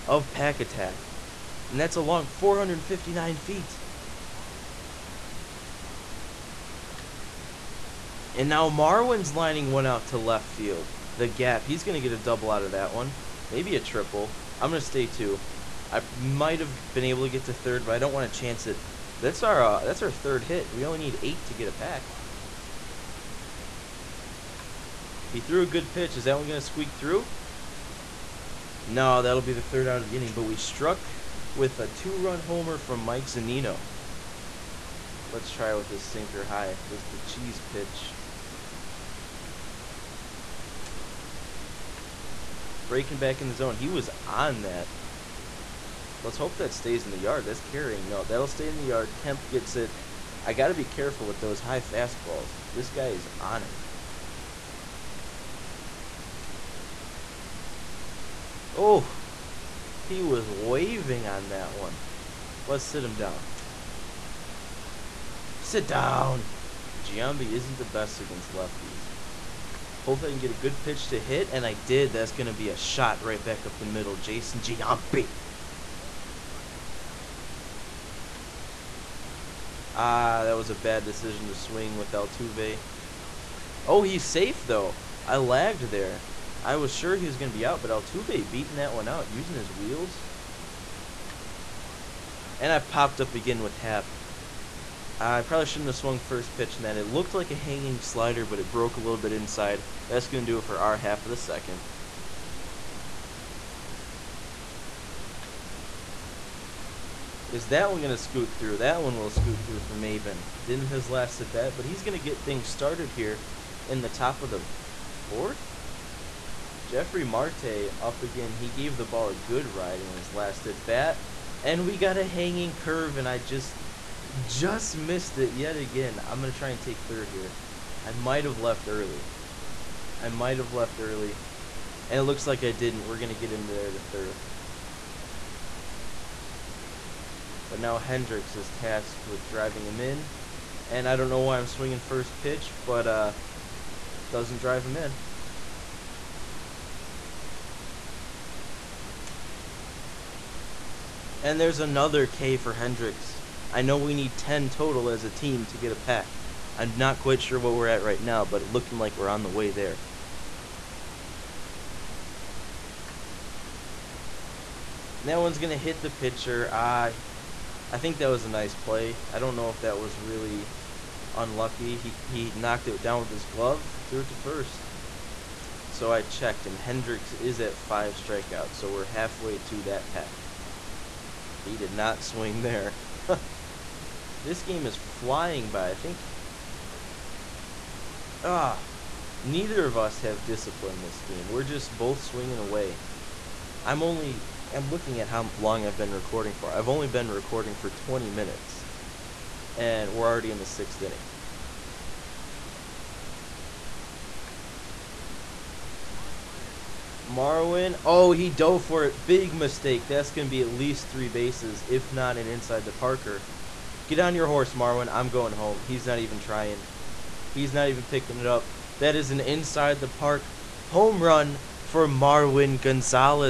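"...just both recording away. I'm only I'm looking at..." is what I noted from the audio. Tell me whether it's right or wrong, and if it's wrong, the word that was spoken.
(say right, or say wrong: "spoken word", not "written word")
wrong: "swinging", not "recording".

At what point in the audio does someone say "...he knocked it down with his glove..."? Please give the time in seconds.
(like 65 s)
172 s.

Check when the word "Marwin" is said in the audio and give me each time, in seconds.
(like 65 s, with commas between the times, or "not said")
8 s, 207 s, 214 s, 222 s.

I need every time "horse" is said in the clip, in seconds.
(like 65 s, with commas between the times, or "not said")
214 s.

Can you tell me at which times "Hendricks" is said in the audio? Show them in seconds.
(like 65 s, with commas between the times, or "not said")
137 s, 152 s, 176 s.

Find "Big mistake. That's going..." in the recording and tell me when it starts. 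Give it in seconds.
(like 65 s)
209 s.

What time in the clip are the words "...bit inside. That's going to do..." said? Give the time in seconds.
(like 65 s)
99 s.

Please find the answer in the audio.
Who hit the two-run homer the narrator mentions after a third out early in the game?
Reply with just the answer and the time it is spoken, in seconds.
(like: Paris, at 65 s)
Mike Zunino, at 33 s.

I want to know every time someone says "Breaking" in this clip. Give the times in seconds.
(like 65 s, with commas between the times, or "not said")
42 s.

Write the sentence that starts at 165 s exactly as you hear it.
And that one's going to hit the pitcher.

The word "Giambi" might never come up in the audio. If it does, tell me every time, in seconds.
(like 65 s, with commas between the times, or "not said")
67 s, 74 s.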